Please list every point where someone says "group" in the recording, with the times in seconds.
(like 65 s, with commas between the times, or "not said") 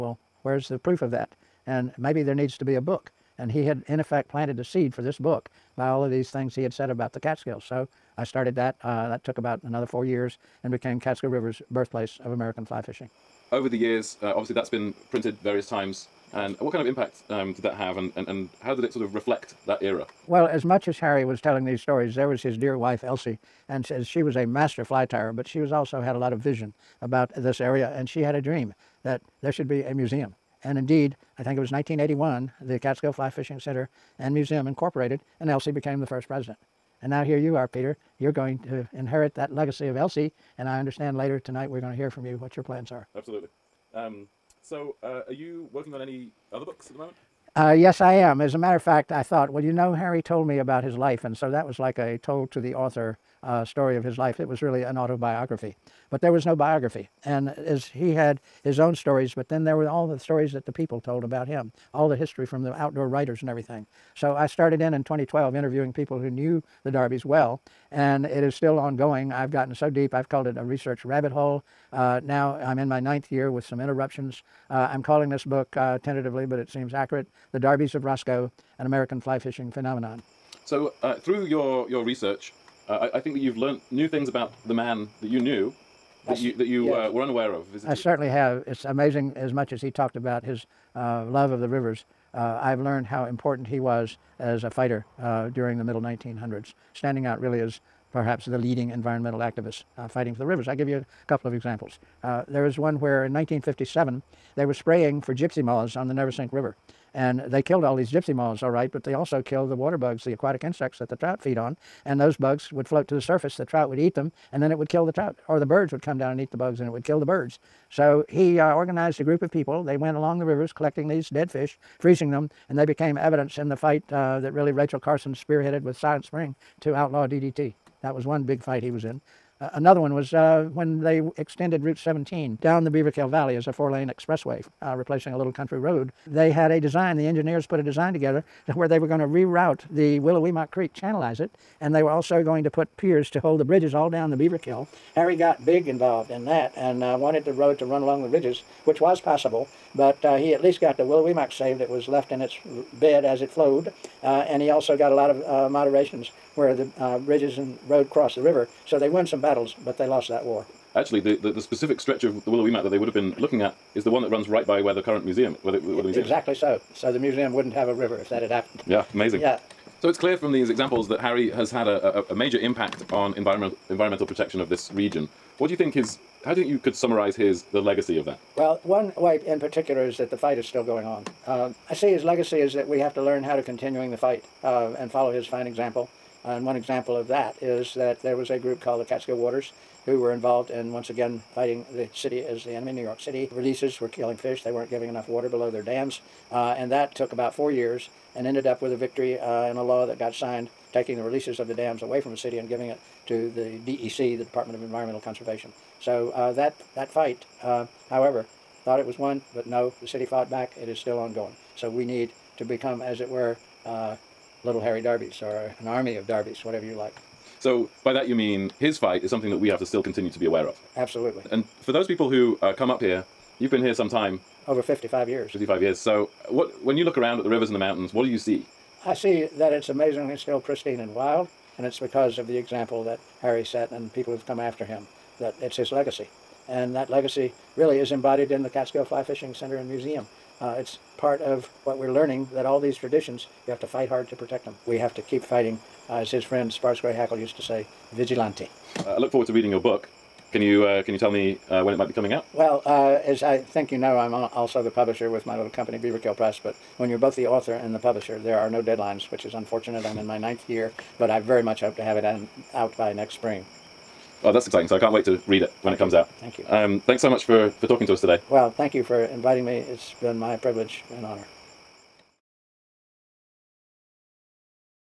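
119 s, 188 s.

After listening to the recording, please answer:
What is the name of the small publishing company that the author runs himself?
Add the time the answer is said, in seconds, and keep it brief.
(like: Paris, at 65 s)
Beaverkill Press, at 255 s.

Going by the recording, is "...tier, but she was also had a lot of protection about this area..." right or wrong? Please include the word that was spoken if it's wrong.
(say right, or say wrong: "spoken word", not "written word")
wrong: "vision", not "protection".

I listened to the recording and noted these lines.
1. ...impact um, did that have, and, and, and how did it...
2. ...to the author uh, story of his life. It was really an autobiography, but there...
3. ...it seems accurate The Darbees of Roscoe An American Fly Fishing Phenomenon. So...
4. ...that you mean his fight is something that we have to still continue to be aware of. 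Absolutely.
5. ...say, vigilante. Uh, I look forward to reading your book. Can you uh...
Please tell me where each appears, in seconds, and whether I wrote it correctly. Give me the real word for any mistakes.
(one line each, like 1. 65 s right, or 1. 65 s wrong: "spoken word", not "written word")
1. 16 s right
2. 52 s right
3. 76 s right
4. 218 s right
5. 247 s right.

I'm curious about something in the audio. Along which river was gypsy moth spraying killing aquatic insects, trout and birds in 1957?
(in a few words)
Neversink River.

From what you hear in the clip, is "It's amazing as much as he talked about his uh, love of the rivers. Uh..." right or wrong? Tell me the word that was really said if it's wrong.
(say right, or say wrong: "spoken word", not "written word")
right.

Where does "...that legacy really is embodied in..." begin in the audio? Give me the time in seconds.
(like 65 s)
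236 s.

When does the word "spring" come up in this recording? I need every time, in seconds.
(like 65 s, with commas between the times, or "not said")
126 s, 263 s.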